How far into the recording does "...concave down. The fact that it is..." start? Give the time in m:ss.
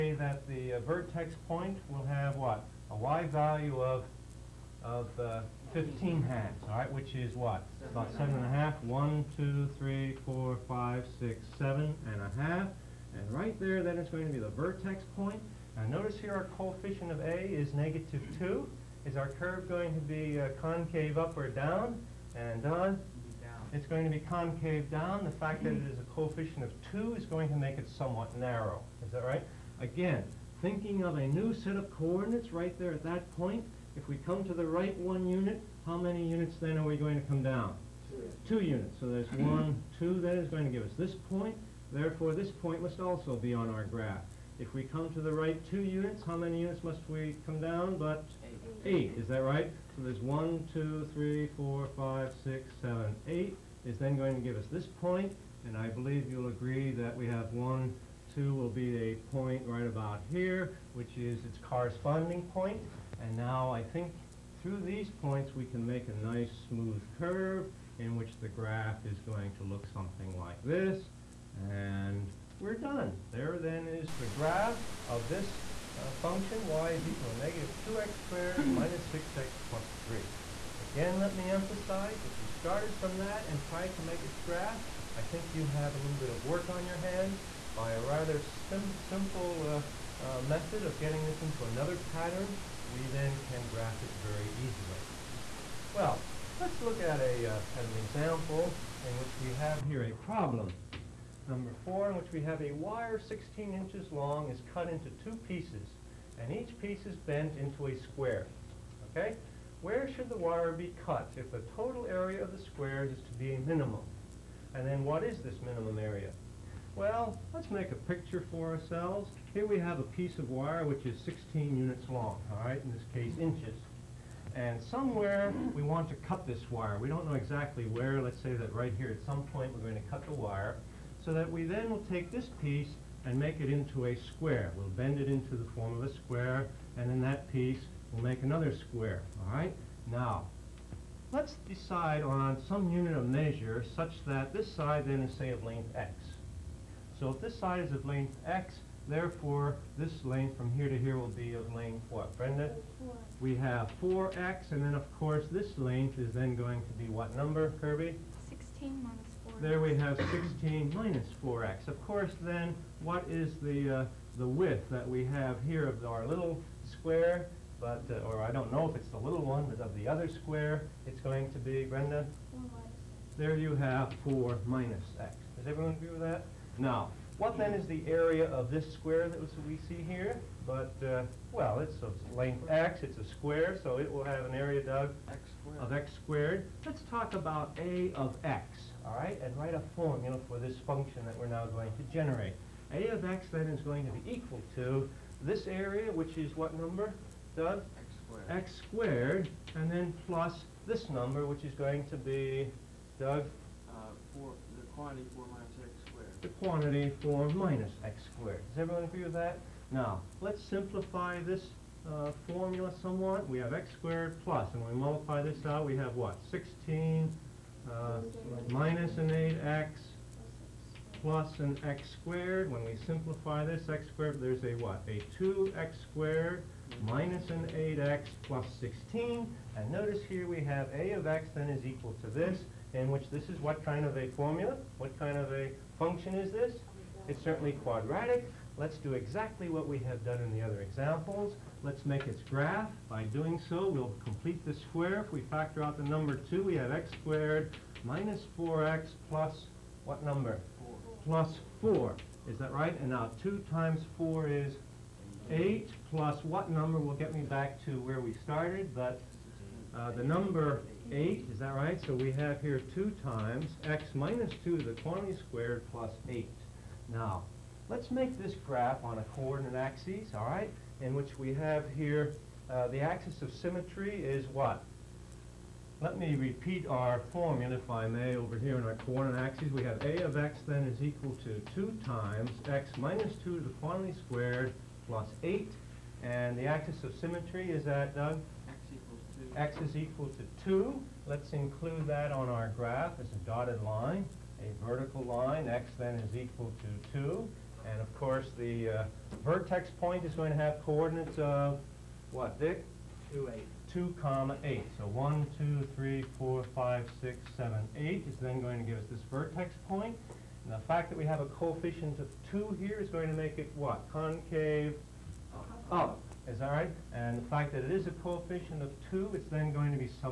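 0:24.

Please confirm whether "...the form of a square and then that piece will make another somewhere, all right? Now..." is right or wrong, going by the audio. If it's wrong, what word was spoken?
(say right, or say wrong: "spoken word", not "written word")
wrong: "square", not "somewhere".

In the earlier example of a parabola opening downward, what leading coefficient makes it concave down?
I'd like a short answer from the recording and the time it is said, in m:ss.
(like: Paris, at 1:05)
-2, at 0:17.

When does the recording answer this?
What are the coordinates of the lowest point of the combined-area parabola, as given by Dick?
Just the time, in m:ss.
5:03.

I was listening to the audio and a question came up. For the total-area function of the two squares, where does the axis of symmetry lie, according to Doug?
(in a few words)
x = 2.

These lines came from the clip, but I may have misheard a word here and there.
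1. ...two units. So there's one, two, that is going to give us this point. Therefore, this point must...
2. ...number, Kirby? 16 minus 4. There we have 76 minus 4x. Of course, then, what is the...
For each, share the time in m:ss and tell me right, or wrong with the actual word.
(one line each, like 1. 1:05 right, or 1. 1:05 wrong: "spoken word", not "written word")
1. 0:38 right
2. 2:37 wrong: "16", not "76".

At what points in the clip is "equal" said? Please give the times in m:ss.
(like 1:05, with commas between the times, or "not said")
1:17, 3:14, 3:51, 4:41, 4:49, 4:56.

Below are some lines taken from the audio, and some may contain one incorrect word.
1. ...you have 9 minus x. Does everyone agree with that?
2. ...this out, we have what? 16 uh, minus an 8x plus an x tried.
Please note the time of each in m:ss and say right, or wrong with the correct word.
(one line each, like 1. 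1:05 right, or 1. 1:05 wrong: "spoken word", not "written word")
1. 2:53 wrong: "4", not "9"
2. 3:35 wrong: "squared", not "tried".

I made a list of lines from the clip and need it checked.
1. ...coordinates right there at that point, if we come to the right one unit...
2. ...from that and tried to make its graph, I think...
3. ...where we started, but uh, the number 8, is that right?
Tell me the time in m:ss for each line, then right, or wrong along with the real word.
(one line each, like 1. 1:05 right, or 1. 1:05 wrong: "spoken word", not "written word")
1. 0:31 right
2. 1:22 right
3. 4:18 right.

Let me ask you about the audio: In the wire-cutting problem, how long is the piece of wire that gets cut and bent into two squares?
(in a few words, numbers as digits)
16 inches.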